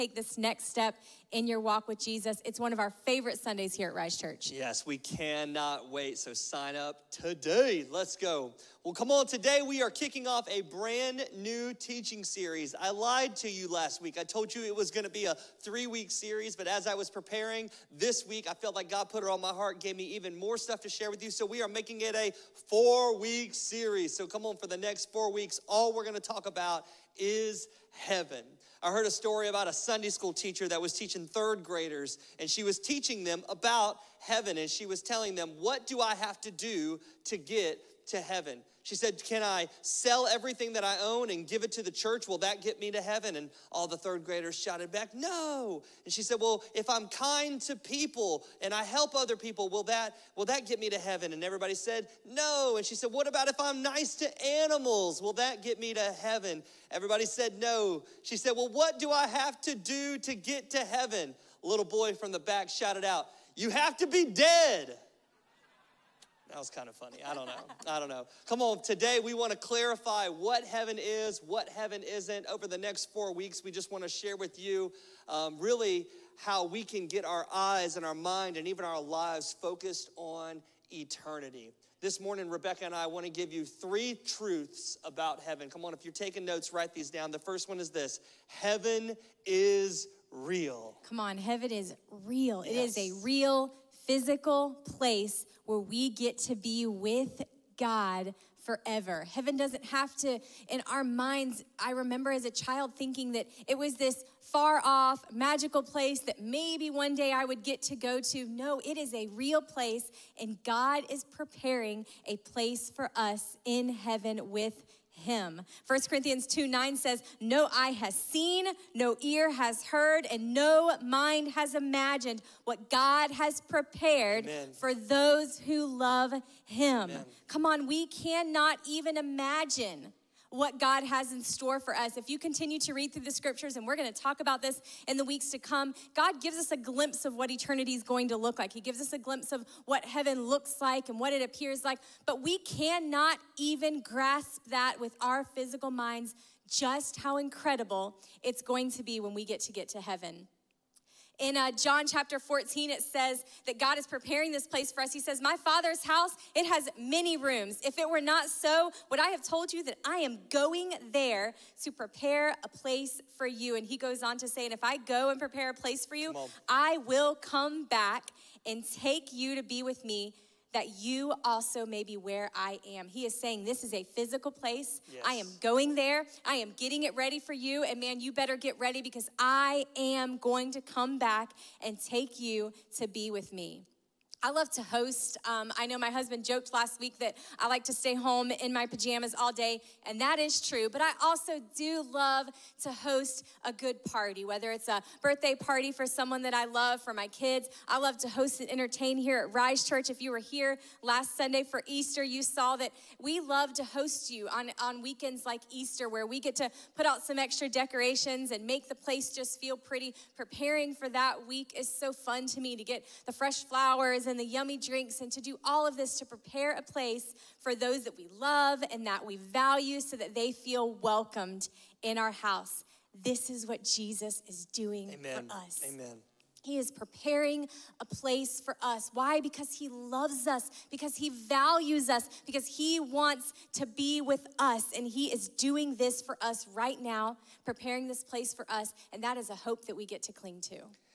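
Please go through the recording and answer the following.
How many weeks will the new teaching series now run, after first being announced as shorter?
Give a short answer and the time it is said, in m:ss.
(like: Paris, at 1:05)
4, at 0:22.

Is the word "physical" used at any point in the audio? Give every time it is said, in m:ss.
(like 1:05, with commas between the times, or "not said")
1:34, 2:25, 2:54.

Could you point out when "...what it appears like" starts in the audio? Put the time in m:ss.
2:21.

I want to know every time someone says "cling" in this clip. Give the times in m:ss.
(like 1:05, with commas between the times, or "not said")
4:00.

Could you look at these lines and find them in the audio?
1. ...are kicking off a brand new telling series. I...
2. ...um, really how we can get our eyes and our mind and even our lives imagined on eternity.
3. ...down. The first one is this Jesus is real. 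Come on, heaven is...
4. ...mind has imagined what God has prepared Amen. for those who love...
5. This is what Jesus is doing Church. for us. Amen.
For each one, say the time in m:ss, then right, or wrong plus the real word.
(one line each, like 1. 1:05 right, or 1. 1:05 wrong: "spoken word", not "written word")
1. 0:09 wrong: "teaching", not "telling"
2. 1:15 wrong: "focused", not "imagined"
3. 1:27 wrong: "Heaven", not "Jesus"
4. 2:01 right
5. 3:43 wrong: "Amen", not "Church".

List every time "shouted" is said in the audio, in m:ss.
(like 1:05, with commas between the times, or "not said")
0:44, 1:02.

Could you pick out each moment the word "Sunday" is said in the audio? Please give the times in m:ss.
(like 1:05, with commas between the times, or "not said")
0:03, 0:29, 3:21.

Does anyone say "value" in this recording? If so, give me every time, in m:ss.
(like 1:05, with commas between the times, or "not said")
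3:39, 3:51.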